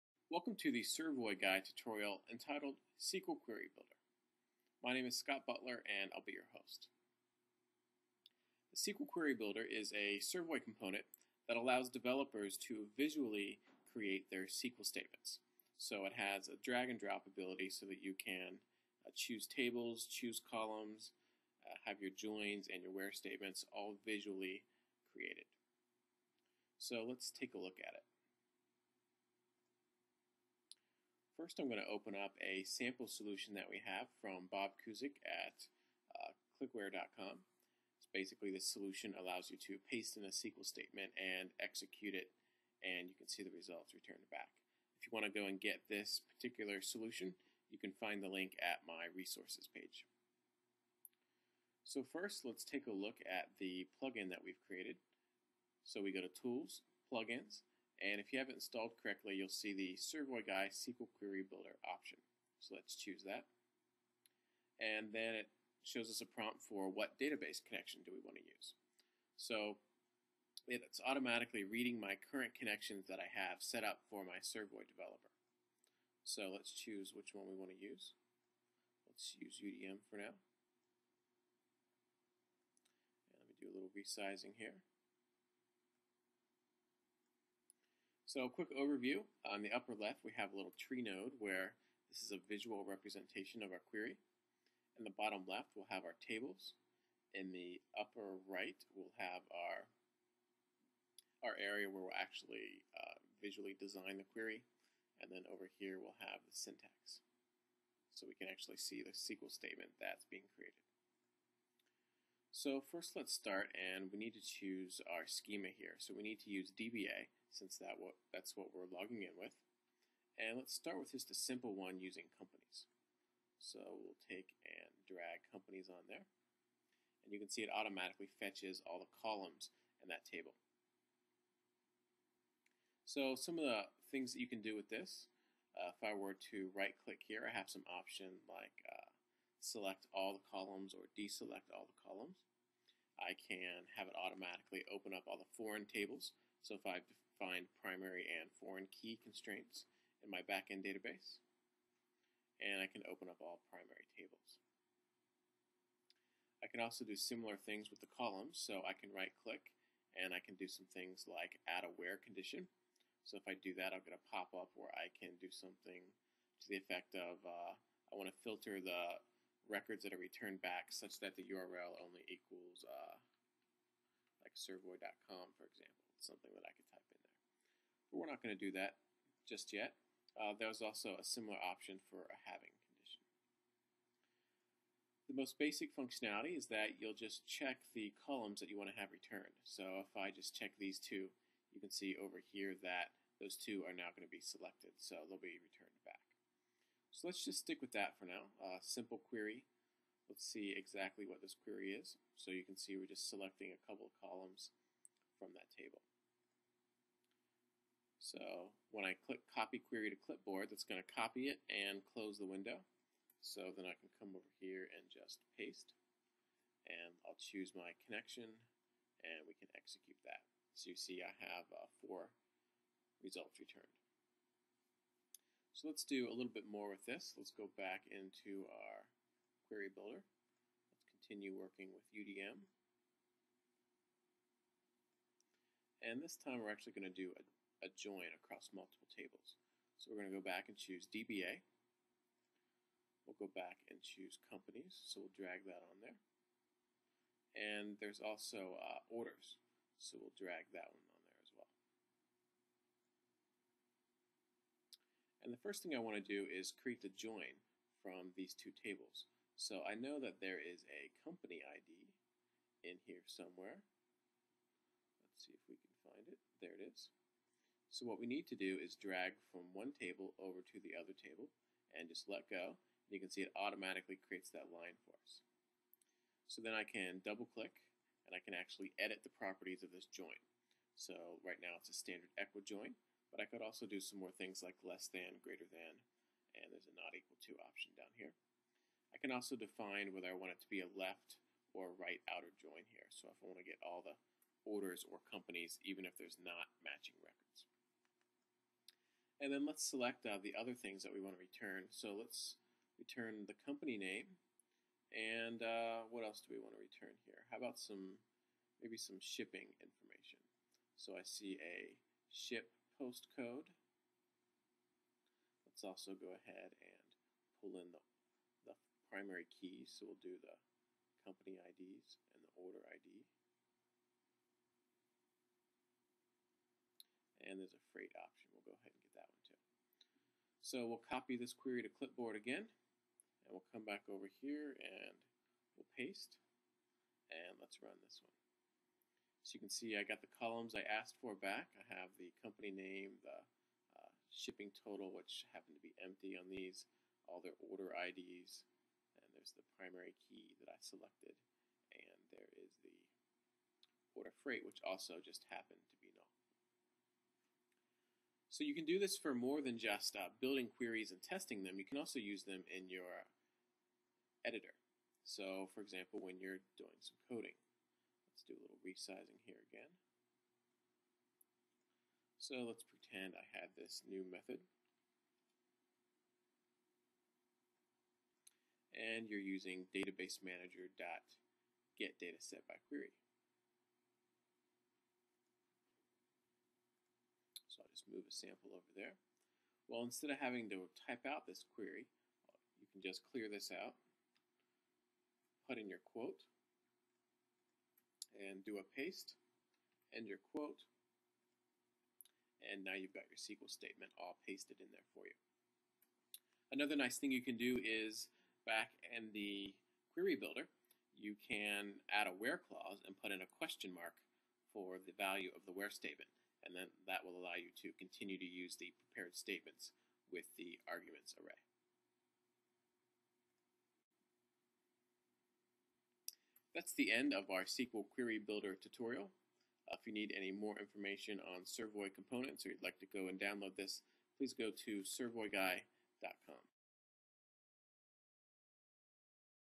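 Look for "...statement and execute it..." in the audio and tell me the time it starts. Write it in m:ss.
0:40.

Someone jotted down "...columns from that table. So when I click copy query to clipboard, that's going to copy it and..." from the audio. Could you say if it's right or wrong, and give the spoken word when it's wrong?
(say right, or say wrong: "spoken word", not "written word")
right.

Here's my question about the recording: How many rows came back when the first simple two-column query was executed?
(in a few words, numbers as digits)
4.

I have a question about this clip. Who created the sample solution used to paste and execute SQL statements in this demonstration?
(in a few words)
Bob Cusick.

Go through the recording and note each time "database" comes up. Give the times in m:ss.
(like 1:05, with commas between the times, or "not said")
1:07, 2:30, 6:19.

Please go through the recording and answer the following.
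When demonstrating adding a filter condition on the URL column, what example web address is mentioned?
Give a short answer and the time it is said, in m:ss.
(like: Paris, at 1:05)
servoy.com, at 2:54.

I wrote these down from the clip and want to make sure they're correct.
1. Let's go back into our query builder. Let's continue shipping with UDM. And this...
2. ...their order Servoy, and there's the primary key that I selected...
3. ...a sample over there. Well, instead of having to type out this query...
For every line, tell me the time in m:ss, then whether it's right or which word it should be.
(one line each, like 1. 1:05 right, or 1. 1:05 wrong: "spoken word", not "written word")
1. 3:47 wrong: "working", not "shipping"
2. 5:47 wrong: "IDs", not "Servoy"
3. 6:28 right.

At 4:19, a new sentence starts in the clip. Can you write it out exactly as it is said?
So I know that there is a company ID in here somewhere.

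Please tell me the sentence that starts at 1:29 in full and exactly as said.
On the upper left, we have a little tree node where this is a visual representation of our query.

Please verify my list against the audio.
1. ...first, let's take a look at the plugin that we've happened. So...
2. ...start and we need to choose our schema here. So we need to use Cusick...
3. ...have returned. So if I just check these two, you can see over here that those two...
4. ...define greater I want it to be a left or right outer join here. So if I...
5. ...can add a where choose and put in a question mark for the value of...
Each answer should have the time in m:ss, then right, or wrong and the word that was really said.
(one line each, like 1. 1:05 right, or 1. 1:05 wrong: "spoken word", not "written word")
1. 0:52 wrong: "created", not "happened"
2. 1:53 wrong: "DBA", not "Cusick"
3. 3:08 right
4. 4:49 wrong: "whether", not "greater"
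5. 6:51 wrong: "clause", not "choose".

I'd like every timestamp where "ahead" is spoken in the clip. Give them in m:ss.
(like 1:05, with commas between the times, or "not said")
5:16, 5:28.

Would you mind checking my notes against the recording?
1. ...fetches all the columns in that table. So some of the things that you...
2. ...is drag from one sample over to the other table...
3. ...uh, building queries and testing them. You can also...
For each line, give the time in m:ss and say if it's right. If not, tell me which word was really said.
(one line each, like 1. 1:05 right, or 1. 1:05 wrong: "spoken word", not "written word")
1. 2:08 right
2. 4:28 wrong: "table", not "sample"
3. 6:00 right.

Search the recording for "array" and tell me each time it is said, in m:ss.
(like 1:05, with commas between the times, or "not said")
7:01.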